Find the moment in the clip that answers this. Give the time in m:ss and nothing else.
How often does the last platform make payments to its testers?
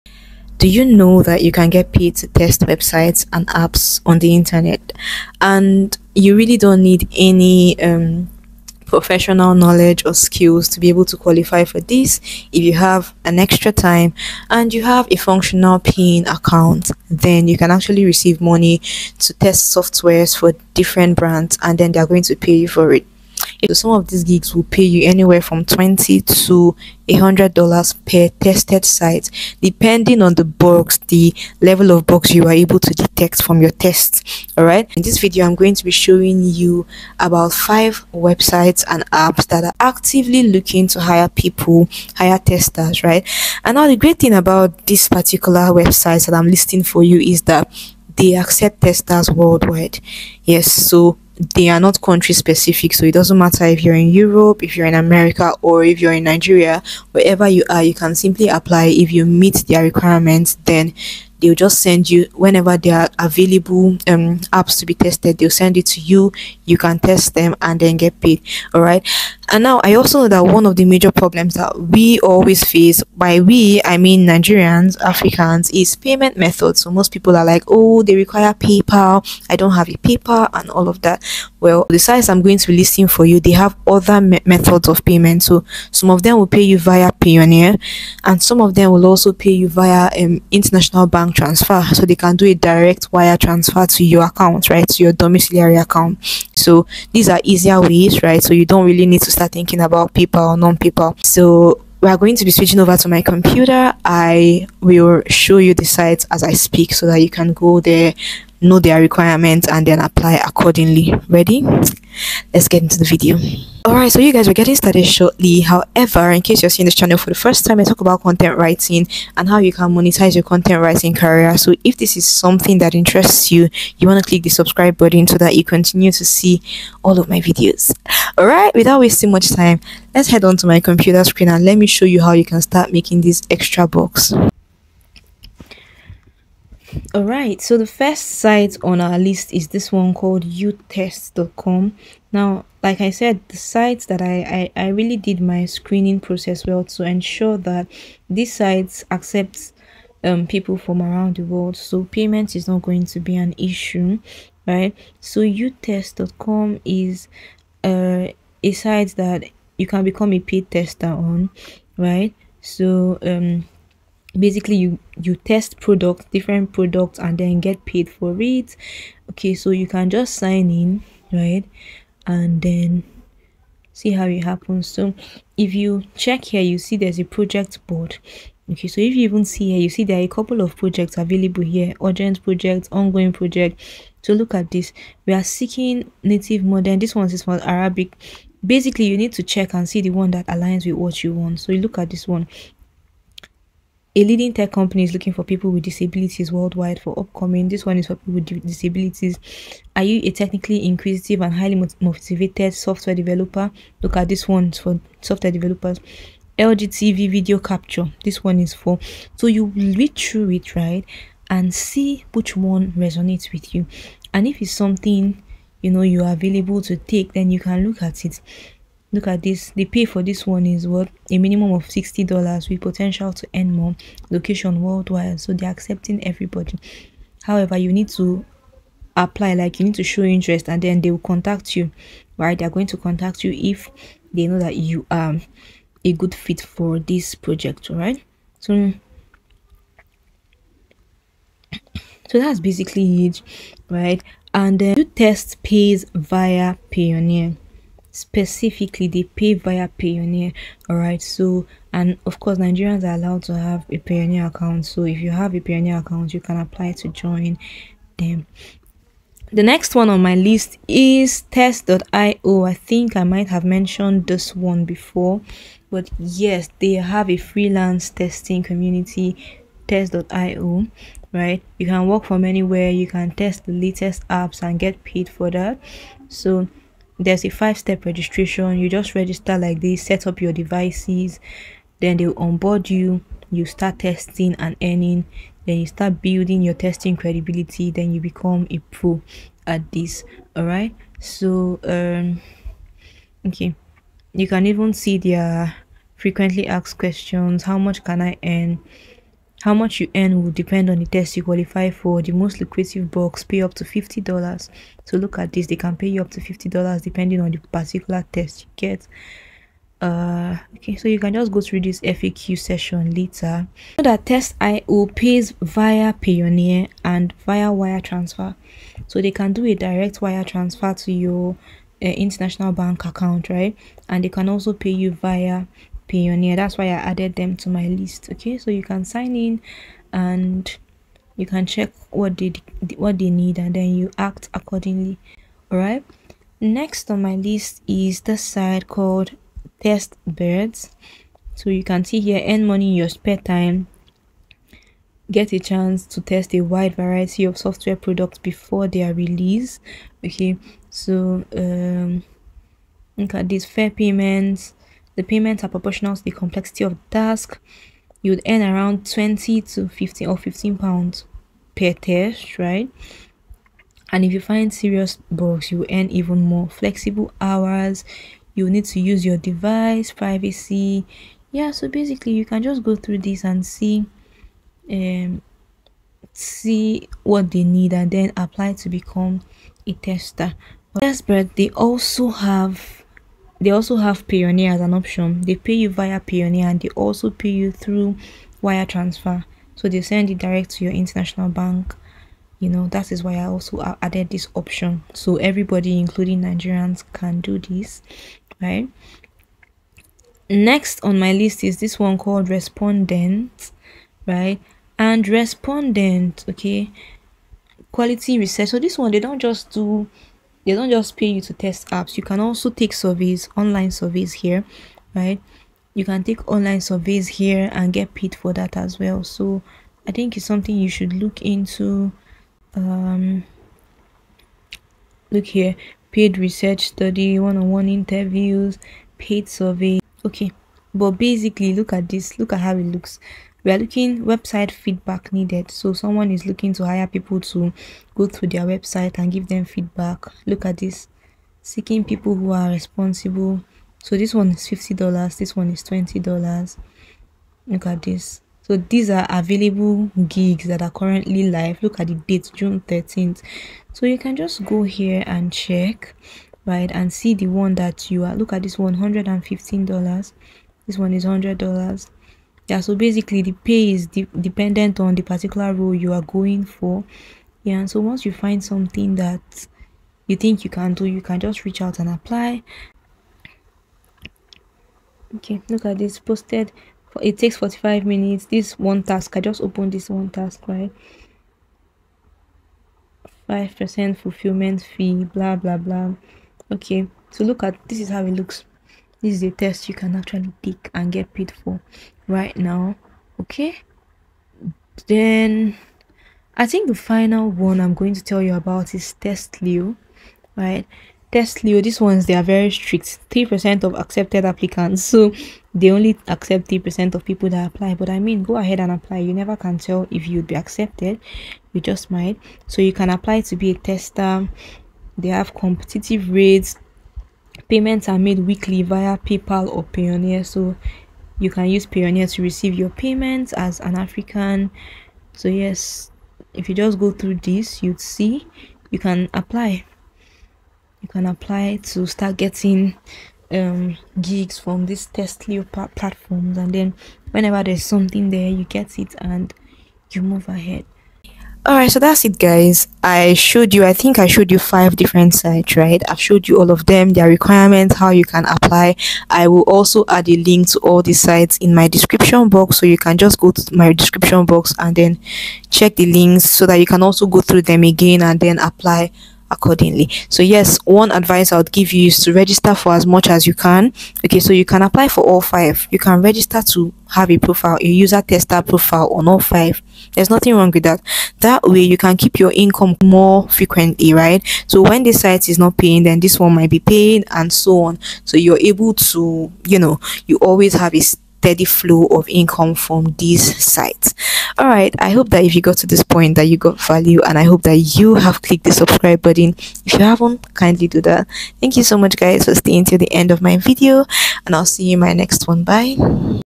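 8:38.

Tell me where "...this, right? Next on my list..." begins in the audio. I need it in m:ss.
6:37.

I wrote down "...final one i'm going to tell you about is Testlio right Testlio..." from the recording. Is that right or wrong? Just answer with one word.
right.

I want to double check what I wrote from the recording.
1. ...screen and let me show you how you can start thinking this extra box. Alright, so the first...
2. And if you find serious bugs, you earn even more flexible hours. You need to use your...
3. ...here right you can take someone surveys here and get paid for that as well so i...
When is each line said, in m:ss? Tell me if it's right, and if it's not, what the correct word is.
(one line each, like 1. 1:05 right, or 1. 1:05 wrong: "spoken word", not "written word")
1. 2:11 wrong: "making", not "thinking"
2. 6:04 right
3. 6:54 wrong: "online", not "someone".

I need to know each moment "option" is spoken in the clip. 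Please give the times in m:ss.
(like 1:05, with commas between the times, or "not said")
6:24, 6:34.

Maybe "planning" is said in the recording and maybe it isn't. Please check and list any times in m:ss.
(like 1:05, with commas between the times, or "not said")
not said.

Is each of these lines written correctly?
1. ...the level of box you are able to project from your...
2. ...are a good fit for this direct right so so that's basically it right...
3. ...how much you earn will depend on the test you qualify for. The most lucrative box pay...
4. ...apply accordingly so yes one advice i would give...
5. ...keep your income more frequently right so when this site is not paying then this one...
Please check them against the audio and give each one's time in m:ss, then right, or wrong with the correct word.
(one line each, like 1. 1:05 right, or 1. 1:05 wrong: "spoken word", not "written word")
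1. 0:31 wrong: "detect", not "project"
2. 3:55 wrong: "project", not "direct"
3. 4:59 right
4. 9:18 right
5. 9:32 right.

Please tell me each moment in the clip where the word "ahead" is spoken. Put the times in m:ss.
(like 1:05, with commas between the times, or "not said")
8:28, 9:00.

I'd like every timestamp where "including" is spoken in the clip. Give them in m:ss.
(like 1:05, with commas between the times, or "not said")
6:35.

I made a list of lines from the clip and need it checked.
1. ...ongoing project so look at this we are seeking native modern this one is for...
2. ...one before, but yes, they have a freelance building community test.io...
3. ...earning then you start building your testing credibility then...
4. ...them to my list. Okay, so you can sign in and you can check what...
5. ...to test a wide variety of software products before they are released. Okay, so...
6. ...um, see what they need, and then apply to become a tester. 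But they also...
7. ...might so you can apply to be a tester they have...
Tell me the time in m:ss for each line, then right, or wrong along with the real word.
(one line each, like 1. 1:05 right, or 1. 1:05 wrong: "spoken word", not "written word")
1. 3:02 right
2. 4:24 wrong: "testing", not "building"
3. 4:44 right
4. 5:27 right
5. 5:46 right
6. 6:14 right
7. 8:32 right.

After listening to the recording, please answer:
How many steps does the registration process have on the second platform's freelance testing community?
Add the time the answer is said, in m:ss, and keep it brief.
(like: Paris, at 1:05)
5, at 4:37.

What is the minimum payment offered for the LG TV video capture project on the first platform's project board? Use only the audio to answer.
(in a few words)
$60.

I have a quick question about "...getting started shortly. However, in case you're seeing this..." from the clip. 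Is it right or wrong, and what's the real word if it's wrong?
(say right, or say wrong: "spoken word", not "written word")
right.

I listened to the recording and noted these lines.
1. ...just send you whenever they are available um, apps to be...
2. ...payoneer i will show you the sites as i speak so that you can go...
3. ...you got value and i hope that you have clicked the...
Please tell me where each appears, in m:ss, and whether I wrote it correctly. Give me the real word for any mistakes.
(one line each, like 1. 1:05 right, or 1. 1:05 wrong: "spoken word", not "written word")
1. 1:01 right
2. 1:43 wrong: "computer", not "payoneer"
3. 9:46 right.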